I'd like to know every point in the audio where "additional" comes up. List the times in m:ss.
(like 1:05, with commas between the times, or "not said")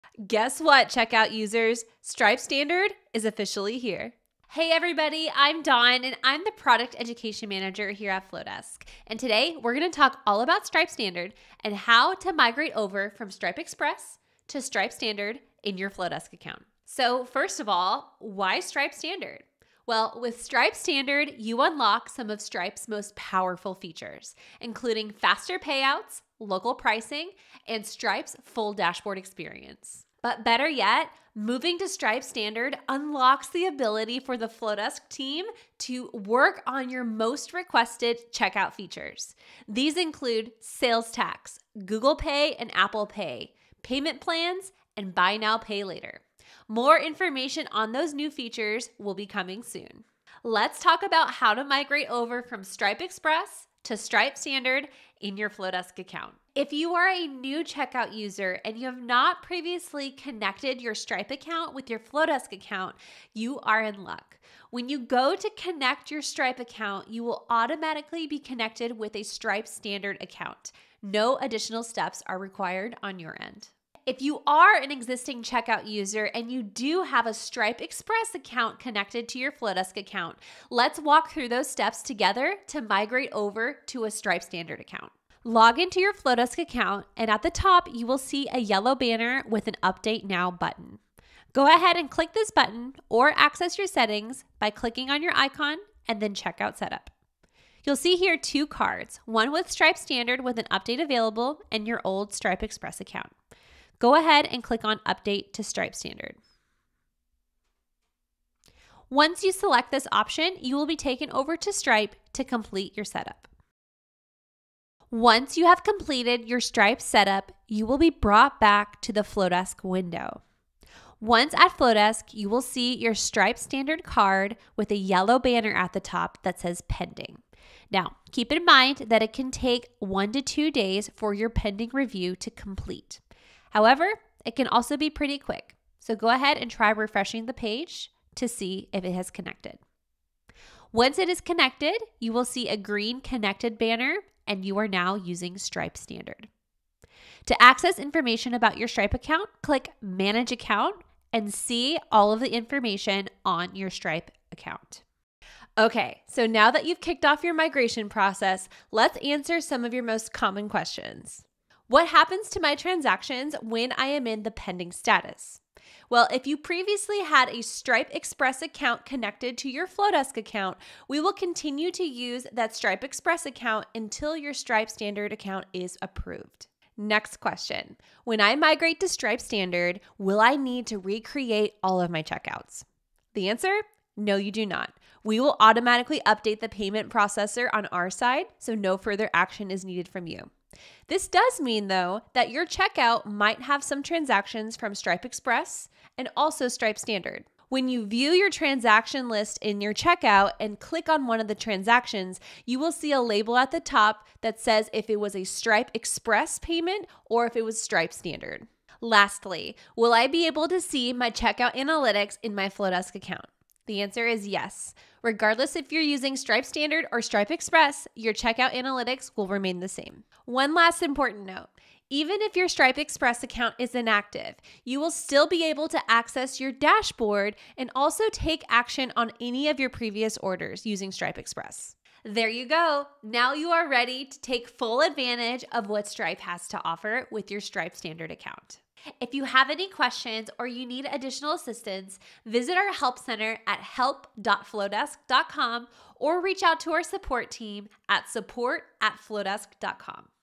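1:11, 4:01.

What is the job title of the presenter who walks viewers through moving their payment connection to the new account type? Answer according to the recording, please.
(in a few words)
Product education manager.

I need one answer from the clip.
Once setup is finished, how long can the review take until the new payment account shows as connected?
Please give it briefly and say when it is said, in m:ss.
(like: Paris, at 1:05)
1 to 2 days, at 2:09.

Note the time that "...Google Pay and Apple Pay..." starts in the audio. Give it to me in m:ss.
0:41.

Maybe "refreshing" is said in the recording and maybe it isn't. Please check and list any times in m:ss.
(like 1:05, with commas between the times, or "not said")
2:16.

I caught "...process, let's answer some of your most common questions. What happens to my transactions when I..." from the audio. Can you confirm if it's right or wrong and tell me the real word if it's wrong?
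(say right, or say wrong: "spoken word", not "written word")
right.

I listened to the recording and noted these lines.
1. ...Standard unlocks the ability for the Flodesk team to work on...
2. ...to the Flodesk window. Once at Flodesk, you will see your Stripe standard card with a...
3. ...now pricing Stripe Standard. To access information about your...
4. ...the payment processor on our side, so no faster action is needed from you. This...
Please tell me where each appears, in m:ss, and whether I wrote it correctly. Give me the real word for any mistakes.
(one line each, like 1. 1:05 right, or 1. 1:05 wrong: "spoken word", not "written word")
1. 0:32 right
2. 1:59 right
3. 2:24 wrong: "using", not "pricing"
4. 3:06 wrong: "further", not "faster".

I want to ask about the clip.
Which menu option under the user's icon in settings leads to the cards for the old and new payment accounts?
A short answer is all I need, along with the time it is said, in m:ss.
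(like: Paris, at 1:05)
Checkout Setup, at 1:36.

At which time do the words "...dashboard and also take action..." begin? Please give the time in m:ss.
3:46.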